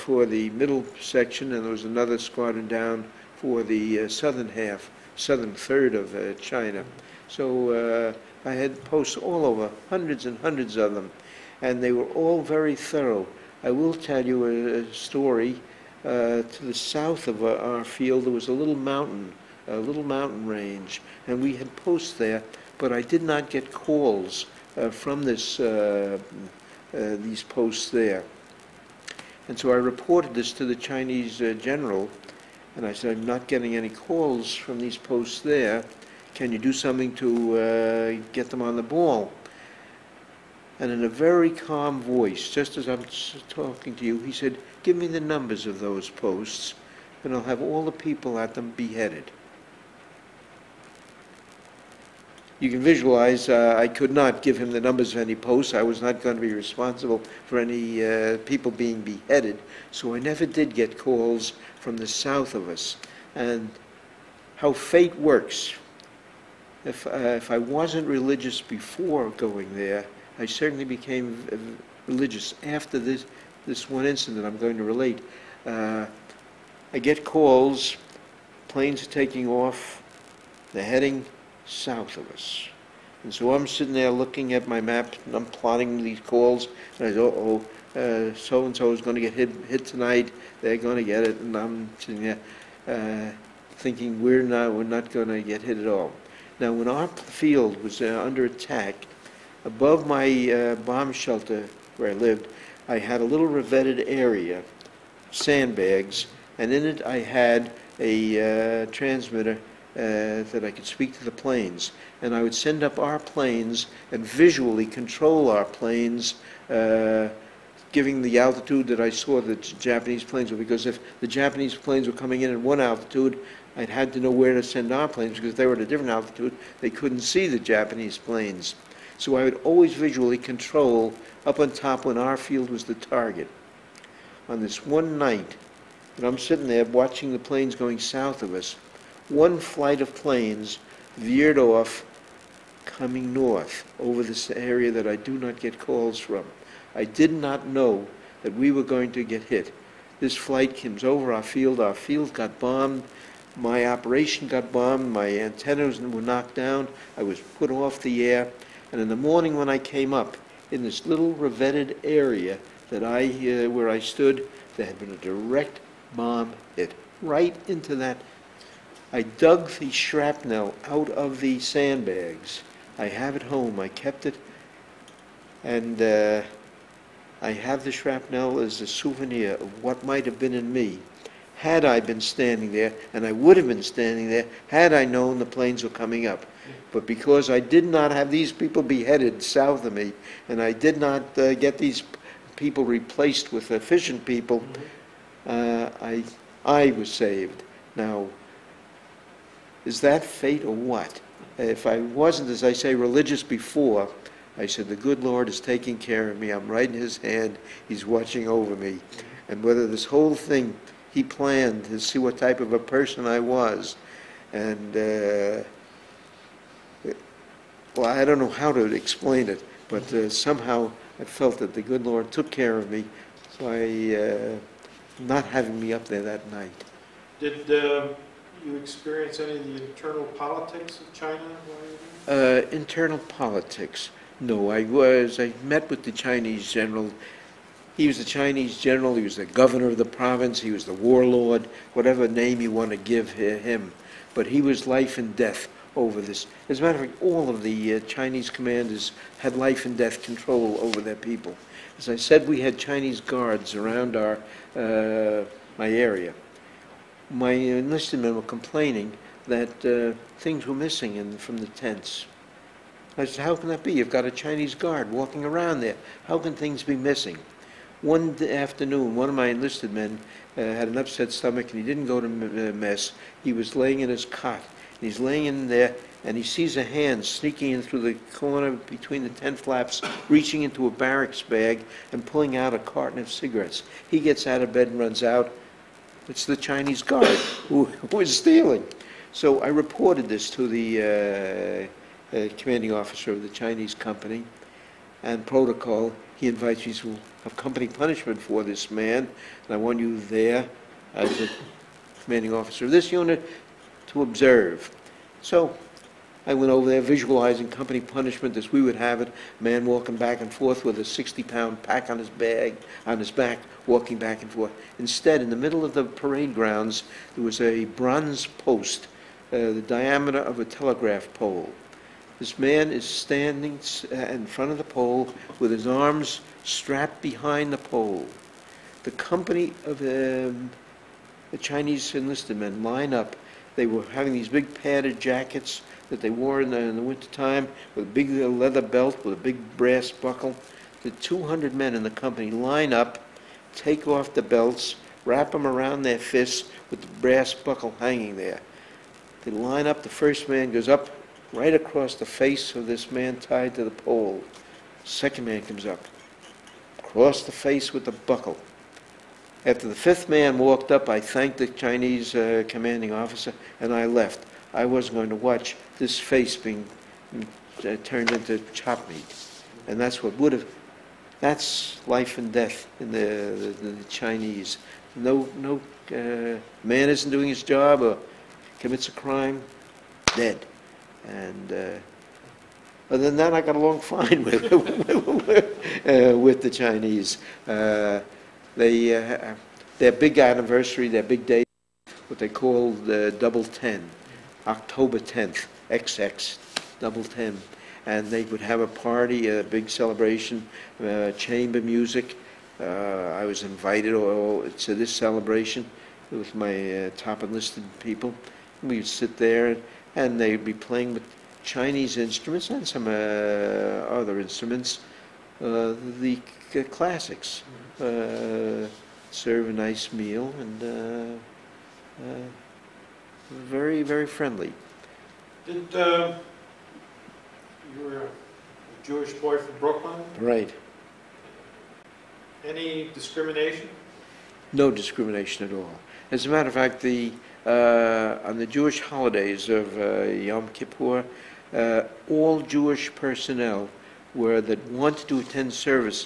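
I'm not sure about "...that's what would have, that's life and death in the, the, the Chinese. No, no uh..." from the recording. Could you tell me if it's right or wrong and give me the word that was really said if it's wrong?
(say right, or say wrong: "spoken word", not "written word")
right.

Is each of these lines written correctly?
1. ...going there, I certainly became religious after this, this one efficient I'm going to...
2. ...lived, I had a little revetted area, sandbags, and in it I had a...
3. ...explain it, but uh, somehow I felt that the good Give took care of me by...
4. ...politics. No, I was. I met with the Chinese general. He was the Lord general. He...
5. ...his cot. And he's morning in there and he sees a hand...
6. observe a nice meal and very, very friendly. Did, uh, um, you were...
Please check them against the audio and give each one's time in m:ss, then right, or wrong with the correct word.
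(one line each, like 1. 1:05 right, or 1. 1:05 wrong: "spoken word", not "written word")
1. 1:09 wrong: "incident", not "efficient"
2. 1:42 right
3. 3:38 wrong: "Lord", not "Give"
4. 3:53 wrong: "Chinese", not "Lord"
5. 4:34 wrong: "laying", not "morning"
6. 6:57 wrong: "serve", not "observe".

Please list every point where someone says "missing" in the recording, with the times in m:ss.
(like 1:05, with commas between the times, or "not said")
4:20, 4:26.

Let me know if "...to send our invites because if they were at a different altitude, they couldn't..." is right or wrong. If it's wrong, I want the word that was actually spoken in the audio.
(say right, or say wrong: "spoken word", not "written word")
wrong: "planes", not "invites".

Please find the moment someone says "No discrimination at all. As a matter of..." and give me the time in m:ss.
7:14.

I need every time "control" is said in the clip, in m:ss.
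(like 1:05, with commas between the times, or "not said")
1:54, 2:10, 4:10.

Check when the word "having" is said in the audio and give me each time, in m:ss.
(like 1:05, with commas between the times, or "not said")
3:45, 5:34.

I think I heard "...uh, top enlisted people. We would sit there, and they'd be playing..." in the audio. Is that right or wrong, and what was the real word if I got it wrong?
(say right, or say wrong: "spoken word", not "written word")
right.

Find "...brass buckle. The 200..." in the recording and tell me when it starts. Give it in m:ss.
5:39.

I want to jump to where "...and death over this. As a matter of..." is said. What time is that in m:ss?
4:05.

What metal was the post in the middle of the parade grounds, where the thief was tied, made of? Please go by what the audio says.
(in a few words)
bronze.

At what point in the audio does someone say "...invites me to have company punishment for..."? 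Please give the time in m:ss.
4:56.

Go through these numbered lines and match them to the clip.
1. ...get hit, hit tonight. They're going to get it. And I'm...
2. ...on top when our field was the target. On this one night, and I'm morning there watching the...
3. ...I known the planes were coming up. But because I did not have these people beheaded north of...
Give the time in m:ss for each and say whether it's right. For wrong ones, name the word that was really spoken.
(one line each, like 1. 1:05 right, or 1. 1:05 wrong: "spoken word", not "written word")
1. 1:29 right
2. 2:11 wrong: "sitting", not "morning"
3. 3:04 wrong: "south", not "north".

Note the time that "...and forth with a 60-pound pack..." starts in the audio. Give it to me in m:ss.
5:10.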